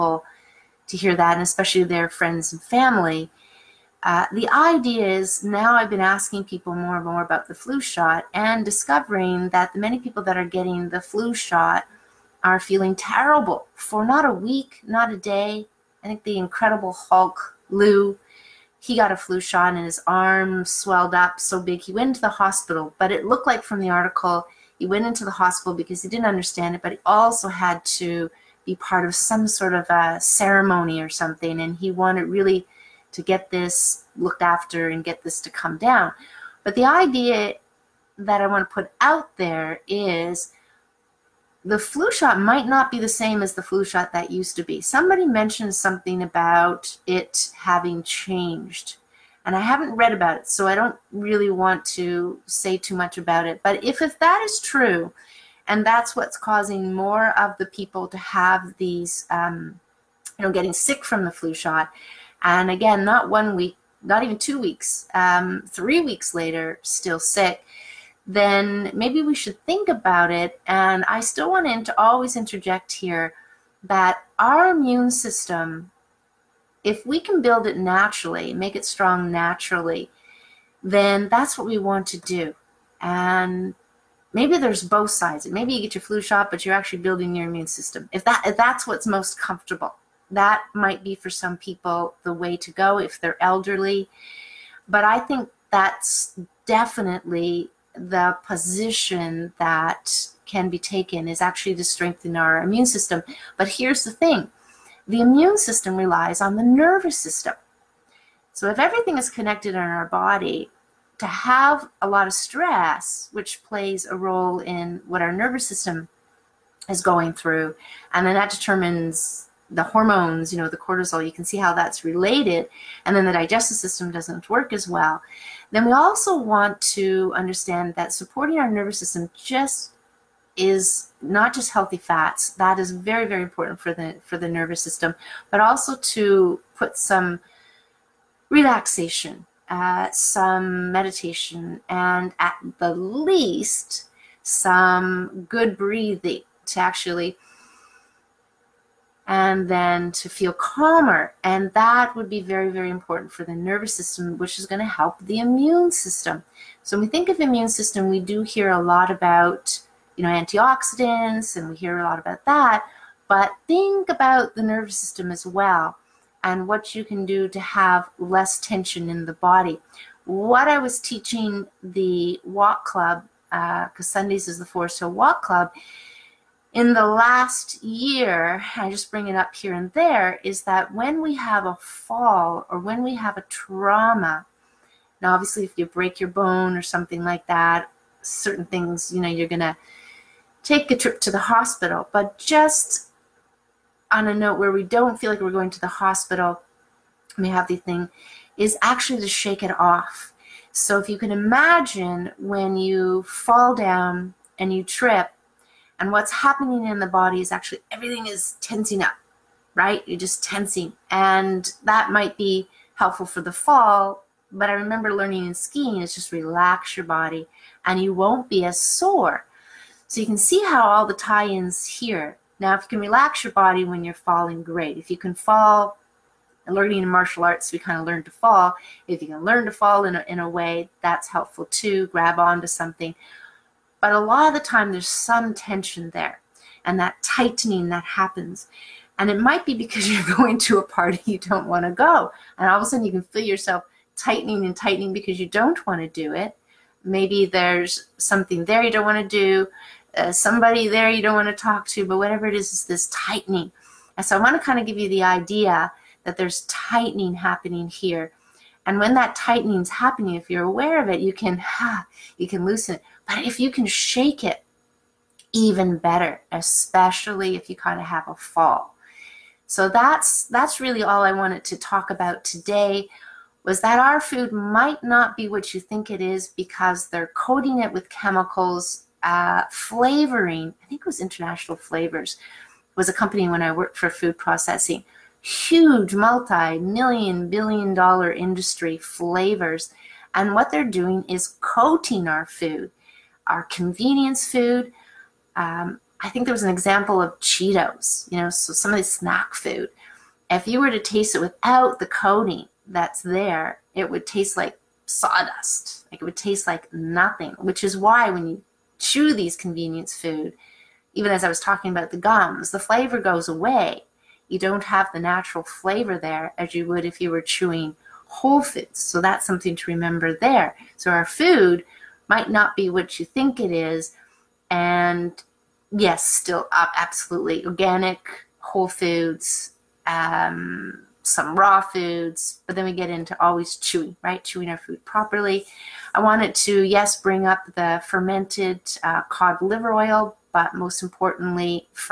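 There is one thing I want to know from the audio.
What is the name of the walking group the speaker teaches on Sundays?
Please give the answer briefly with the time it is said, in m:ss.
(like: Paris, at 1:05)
Forest Hill Walk Club, at 2:54.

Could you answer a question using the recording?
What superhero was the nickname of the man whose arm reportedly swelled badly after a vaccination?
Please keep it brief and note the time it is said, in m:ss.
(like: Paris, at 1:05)
The Incredible Hulk, at 0:16.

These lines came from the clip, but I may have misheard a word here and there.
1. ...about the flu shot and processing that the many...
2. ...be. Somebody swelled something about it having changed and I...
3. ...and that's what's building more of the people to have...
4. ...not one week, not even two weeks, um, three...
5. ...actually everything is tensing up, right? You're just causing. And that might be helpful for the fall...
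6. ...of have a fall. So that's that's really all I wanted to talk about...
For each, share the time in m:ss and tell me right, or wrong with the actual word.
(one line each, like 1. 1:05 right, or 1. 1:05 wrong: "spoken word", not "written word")
1. 0:07 wrong: "discovering", not "processing"
2. 0:44 wrong: "mentioned", not "swelled"
3. 0:55 wrong: "causing", not "building"
4. 1:03 right
5. 3:27 wrong: "tensing", not "causing"
6. 4:27 right.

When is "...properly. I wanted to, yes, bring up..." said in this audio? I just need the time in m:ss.
5:35.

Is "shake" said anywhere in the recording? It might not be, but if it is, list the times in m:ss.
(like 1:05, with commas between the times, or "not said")
3:19, 4:23.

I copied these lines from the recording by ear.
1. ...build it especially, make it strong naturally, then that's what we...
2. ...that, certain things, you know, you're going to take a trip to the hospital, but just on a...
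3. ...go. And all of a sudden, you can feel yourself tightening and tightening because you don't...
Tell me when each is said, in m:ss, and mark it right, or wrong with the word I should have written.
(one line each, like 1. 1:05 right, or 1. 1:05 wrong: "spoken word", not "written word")
1. 1:17 wrong: "naturally", not "especially"
2. 3:07 right
3. 4:01 right.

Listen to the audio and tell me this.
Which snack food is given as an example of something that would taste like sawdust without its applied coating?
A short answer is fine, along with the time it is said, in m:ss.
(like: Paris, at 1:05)
Cheetos, at 4:57.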